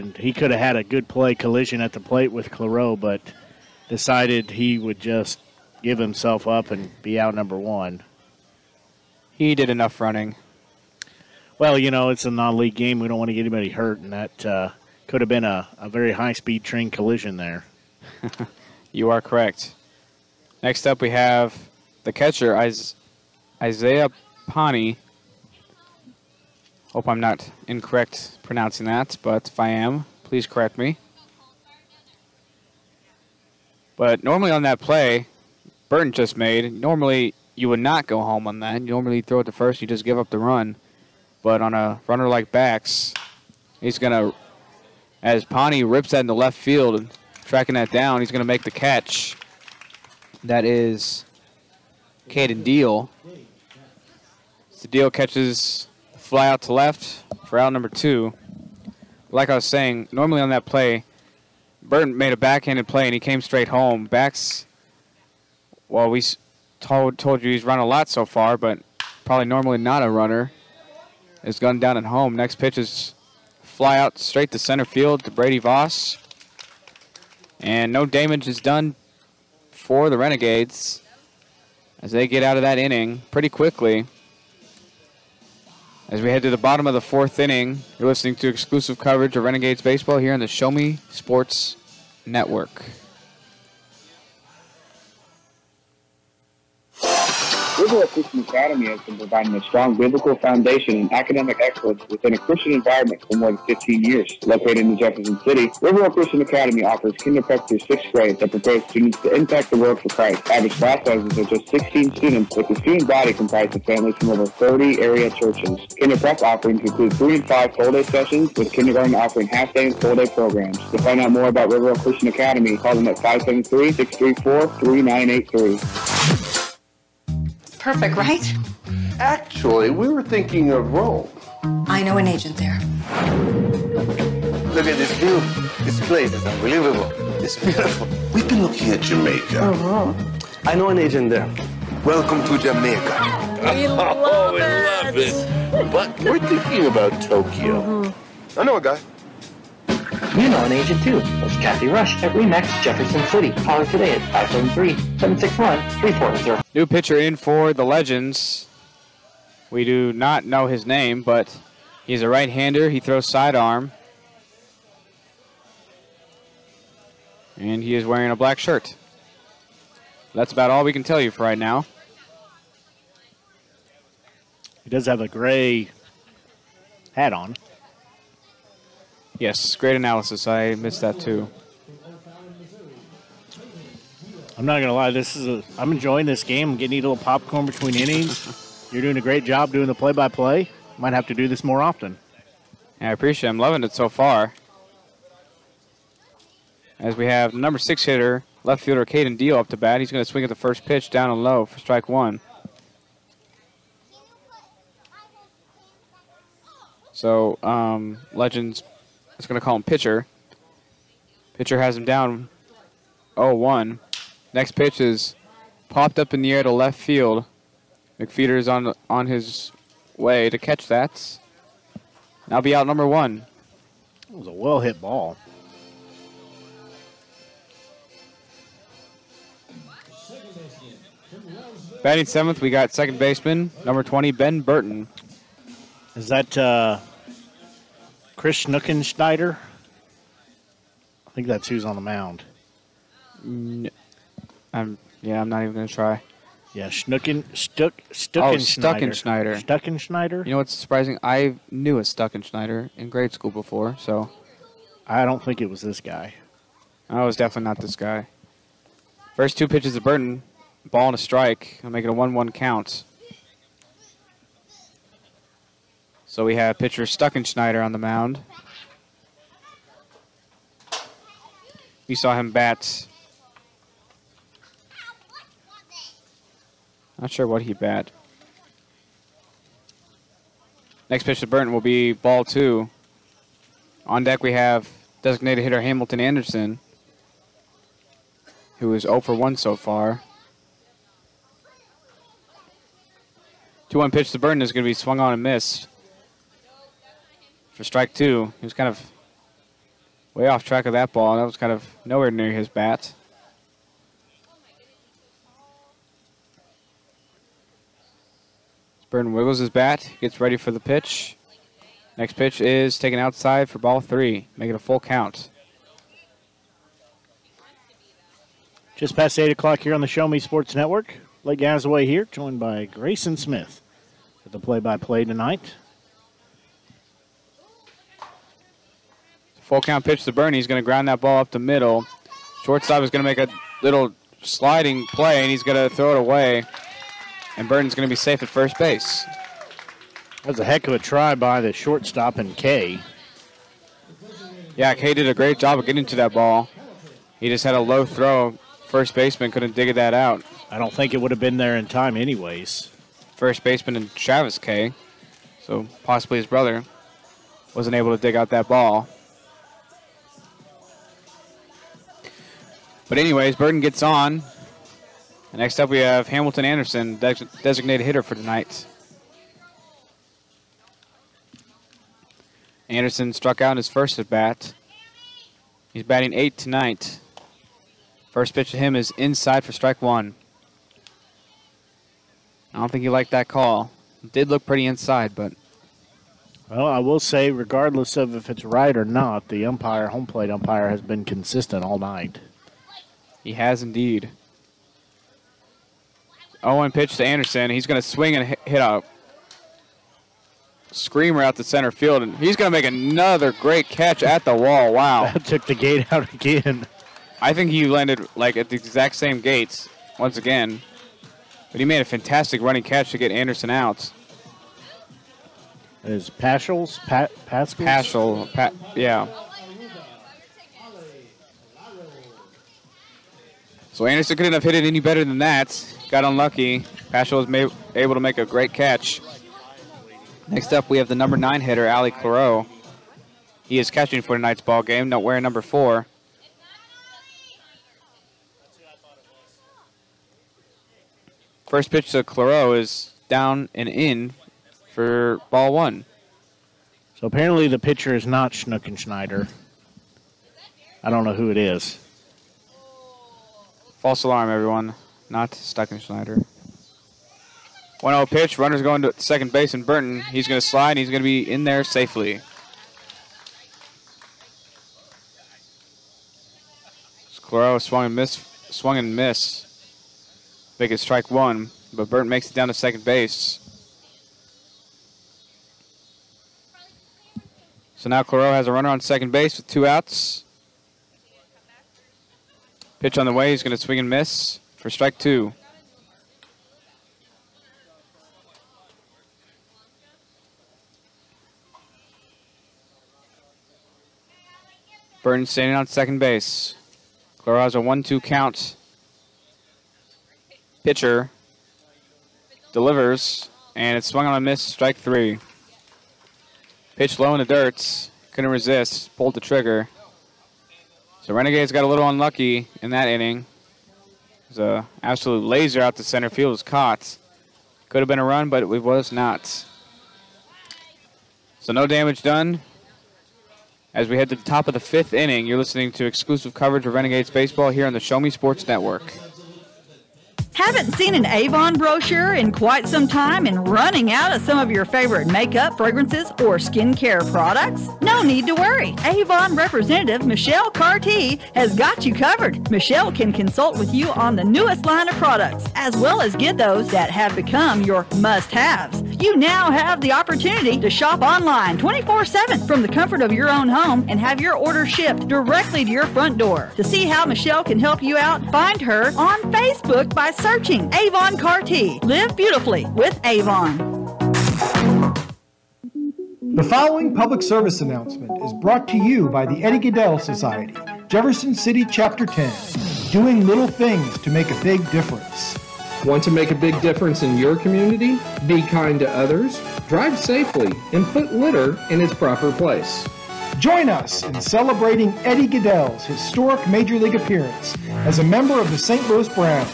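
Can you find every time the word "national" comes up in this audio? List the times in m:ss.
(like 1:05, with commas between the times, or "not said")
not said.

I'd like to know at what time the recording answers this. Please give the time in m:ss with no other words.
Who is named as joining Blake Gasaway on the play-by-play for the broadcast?
5:22.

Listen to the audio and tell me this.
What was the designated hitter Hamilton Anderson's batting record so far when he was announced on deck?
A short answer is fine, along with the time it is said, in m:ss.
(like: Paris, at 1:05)
0 for 1, at 4:49.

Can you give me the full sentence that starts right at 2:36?
New pitcher in for the Legends.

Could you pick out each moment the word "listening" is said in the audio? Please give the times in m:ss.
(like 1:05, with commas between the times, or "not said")
1:28, 8:45.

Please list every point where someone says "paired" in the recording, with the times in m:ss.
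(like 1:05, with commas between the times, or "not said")
not said.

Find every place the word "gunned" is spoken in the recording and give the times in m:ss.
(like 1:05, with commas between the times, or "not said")
1:11.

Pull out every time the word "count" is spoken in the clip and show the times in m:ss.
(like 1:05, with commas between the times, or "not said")
4:22, 5:14, 5:29, 8:18.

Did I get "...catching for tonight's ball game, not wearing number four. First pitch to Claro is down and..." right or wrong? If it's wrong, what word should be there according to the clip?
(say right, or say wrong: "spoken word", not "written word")
right.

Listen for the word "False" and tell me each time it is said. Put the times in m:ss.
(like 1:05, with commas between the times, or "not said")
7:33.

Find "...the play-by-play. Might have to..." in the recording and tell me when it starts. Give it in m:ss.
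3:09.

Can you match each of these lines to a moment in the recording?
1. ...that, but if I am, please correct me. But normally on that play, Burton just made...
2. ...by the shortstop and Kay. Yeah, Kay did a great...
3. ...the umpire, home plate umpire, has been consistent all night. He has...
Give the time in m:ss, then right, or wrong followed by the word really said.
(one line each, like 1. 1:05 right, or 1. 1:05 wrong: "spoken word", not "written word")
1. 0:28 right
2. 5:41 right
3. 6:29 right.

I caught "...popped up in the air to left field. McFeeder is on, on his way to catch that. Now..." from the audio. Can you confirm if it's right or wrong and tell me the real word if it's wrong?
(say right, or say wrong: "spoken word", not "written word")
right.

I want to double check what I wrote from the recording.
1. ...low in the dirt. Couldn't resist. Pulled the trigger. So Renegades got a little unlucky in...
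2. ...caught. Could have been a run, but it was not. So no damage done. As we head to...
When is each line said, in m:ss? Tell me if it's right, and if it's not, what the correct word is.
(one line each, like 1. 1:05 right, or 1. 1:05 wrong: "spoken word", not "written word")
1. 8:27 right
2. 8:36 right.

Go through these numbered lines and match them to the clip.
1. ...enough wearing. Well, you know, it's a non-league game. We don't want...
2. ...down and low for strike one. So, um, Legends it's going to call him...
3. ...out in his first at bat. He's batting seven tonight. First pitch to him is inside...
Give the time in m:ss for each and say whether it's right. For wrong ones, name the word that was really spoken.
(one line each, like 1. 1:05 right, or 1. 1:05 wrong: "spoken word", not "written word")
1. 0:09 wrong: "running", not "wearing"
2. 3:21 right
3. 6:13 wrong: "eight", not "seven".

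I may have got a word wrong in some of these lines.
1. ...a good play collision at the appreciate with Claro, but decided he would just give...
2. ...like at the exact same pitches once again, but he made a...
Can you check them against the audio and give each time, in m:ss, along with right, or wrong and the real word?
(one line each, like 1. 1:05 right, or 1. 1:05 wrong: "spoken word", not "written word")
1. 0:00 wrong: "plate", not "appreciate"
2. 6:48 wrong: "gates", not "pitches".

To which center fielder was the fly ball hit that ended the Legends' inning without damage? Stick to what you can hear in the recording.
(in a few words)
Brady Voss.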